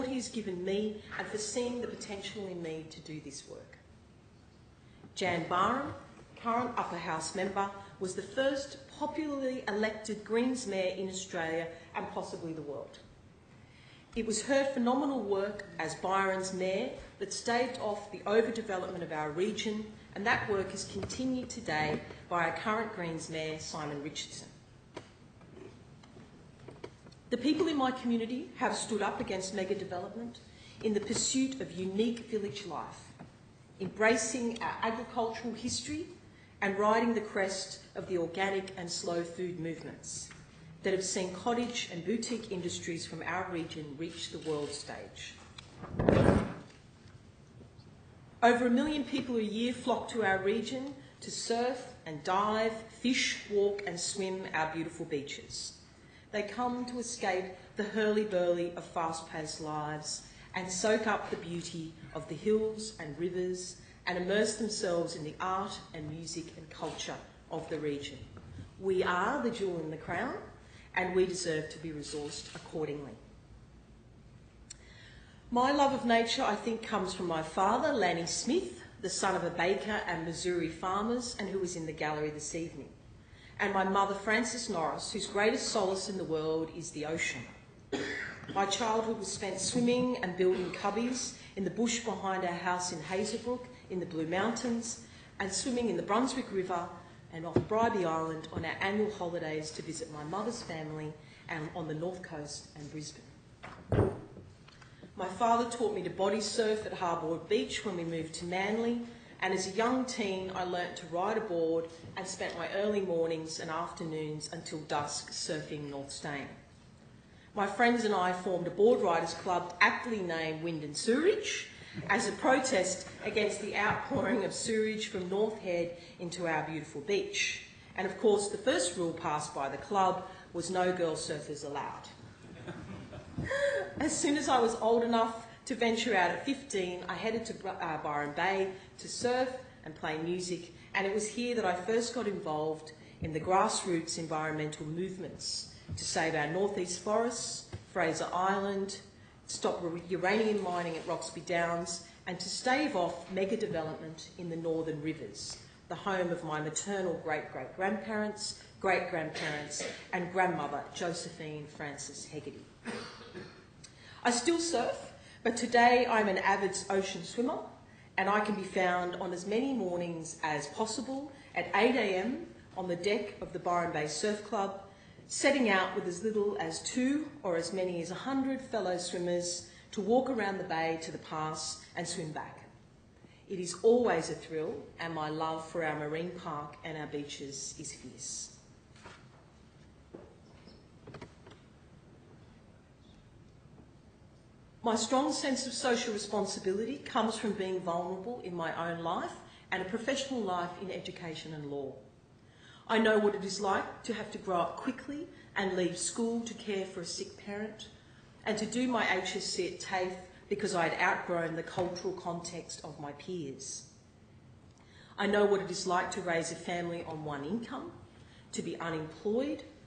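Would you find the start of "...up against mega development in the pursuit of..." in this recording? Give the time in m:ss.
0:29.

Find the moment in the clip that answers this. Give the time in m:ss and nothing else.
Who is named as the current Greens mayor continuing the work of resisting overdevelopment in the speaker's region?
0:23.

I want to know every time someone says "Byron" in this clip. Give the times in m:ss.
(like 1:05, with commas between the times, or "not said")
0:15, 2:18, 2:53.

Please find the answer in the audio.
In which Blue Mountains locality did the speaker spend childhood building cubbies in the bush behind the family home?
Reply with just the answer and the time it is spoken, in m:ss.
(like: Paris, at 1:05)
Hazelbrook, at 1:33.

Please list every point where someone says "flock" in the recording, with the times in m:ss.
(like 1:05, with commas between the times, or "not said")
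0:49.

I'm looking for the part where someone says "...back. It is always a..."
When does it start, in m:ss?
3:02.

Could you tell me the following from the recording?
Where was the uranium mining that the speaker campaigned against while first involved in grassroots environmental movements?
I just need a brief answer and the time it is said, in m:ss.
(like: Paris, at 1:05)
Roxby Downs, at 2:31.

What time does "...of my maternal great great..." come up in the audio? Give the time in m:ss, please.
2:36.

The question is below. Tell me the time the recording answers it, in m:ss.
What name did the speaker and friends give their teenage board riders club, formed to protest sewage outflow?
2:00.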